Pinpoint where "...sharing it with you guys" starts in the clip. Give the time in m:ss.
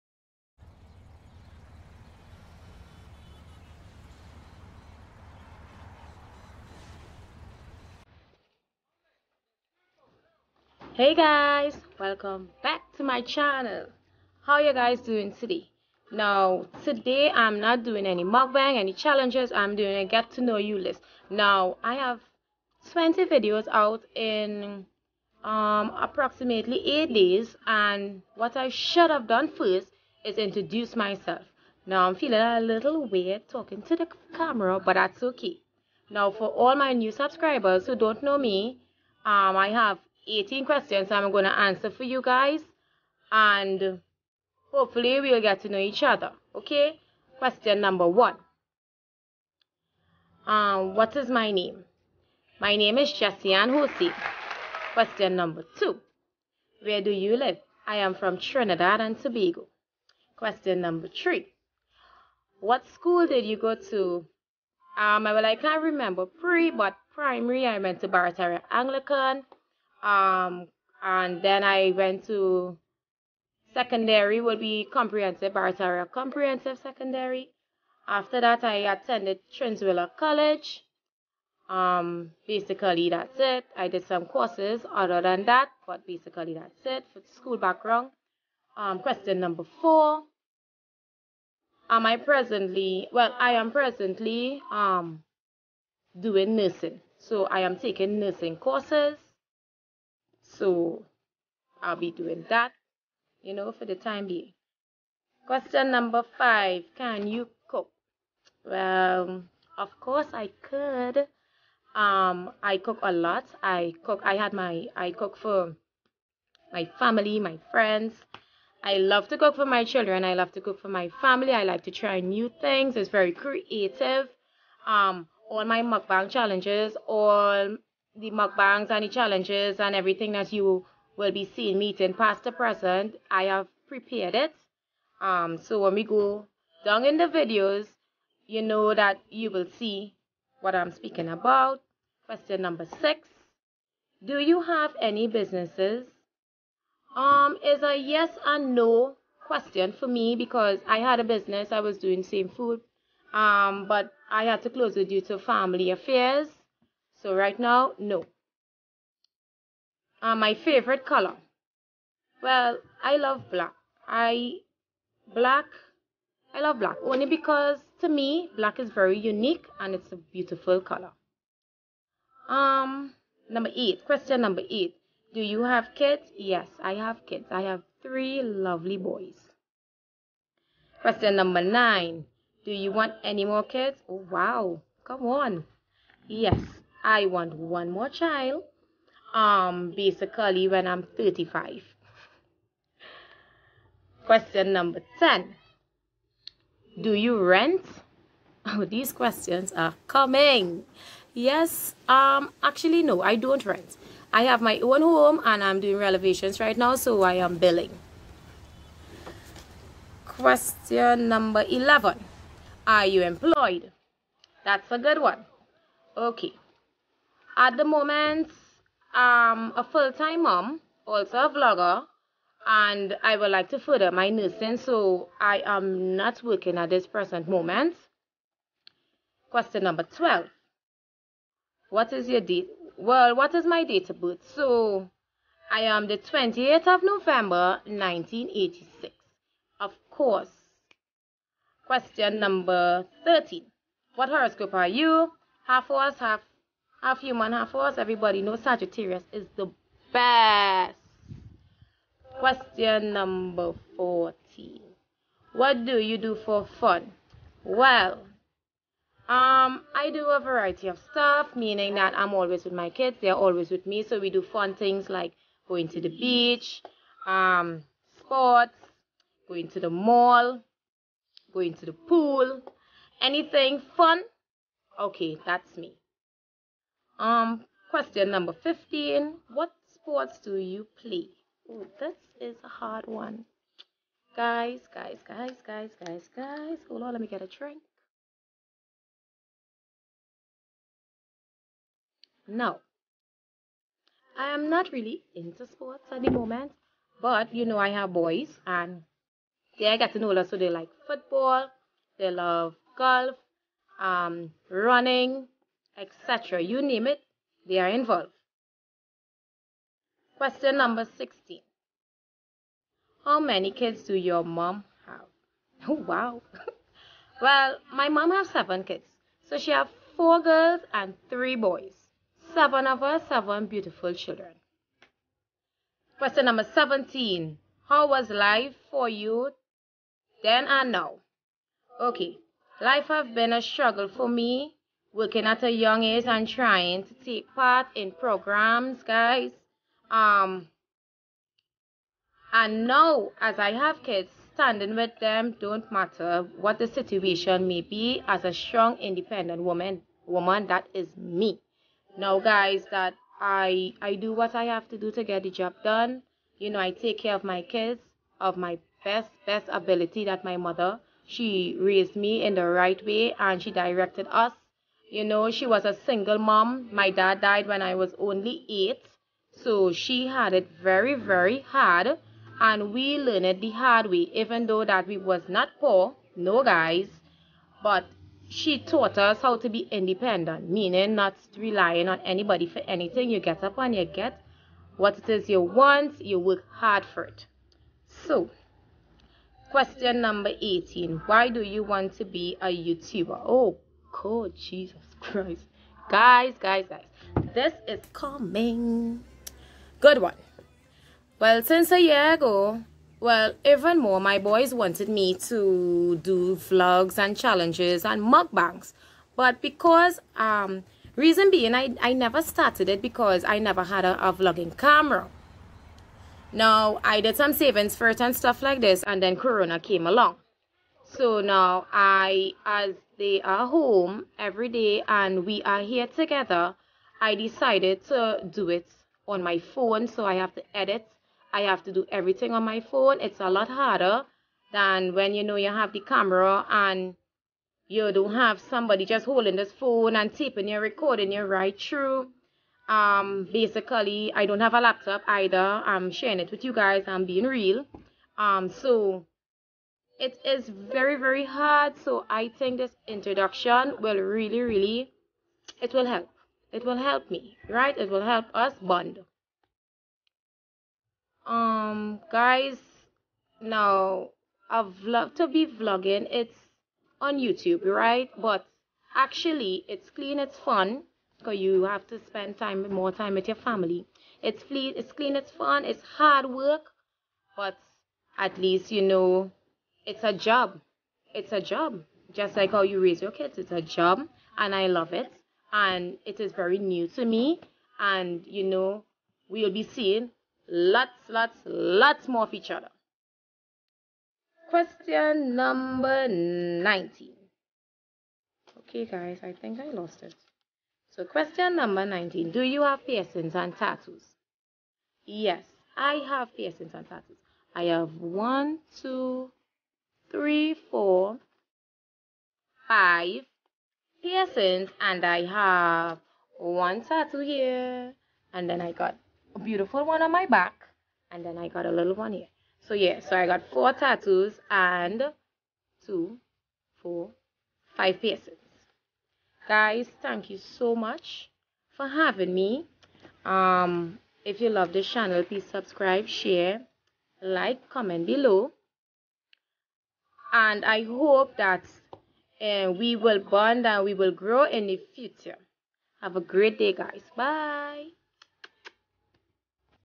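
7:26.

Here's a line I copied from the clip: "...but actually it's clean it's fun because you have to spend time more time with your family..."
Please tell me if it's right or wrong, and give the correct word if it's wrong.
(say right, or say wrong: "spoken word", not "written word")
right.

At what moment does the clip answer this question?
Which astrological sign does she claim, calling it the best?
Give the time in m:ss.
4:08.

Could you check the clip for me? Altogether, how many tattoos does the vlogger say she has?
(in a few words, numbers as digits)
4.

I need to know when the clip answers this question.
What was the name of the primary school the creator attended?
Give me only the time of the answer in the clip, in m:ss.
1:08.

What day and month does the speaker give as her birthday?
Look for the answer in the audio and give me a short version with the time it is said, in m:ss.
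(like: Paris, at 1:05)
28th of November, at 3:56.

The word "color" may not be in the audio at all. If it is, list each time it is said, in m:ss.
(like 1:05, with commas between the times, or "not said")
2:41, 2:50.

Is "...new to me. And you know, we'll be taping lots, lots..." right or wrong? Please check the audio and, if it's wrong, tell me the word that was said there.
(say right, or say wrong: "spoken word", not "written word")
wrong: "seeing", not "taping".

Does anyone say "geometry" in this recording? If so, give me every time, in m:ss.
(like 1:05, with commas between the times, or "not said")
not said.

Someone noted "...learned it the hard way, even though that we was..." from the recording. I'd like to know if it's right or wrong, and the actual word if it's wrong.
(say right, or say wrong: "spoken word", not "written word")
right.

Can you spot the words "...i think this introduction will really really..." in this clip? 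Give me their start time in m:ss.
7:32.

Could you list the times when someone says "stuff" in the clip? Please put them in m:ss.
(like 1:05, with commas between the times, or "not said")
4:21, 6:58.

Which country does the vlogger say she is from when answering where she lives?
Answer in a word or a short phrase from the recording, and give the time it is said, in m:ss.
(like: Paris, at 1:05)
Trinidad and Tobago, at 0:58.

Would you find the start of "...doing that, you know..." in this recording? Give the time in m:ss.
1:42.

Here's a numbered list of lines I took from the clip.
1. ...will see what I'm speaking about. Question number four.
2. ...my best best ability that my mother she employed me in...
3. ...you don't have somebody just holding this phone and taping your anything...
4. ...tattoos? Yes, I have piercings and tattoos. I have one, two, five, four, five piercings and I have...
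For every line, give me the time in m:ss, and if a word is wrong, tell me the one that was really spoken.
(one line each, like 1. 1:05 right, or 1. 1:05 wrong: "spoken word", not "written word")
1. 2:19 wrong: "six", not "four"
2. 5:58 wrong: "raised", not "employed"
3. 7:17 wrong: "recording", not "anything"
4. 8:23 wrong: "three", not "five".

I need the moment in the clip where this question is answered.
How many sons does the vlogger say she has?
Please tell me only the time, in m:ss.
2:58.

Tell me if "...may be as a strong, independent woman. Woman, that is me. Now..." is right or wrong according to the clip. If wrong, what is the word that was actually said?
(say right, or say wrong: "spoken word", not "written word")
right.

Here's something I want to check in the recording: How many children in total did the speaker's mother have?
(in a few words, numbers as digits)
7.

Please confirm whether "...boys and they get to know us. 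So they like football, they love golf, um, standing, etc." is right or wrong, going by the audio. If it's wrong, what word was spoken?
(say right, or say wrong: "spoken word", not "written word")
wrong: "running", not "standing".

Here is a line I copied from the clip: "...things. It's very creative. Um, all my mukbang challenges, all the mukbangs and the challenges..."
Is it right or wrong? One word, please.
right.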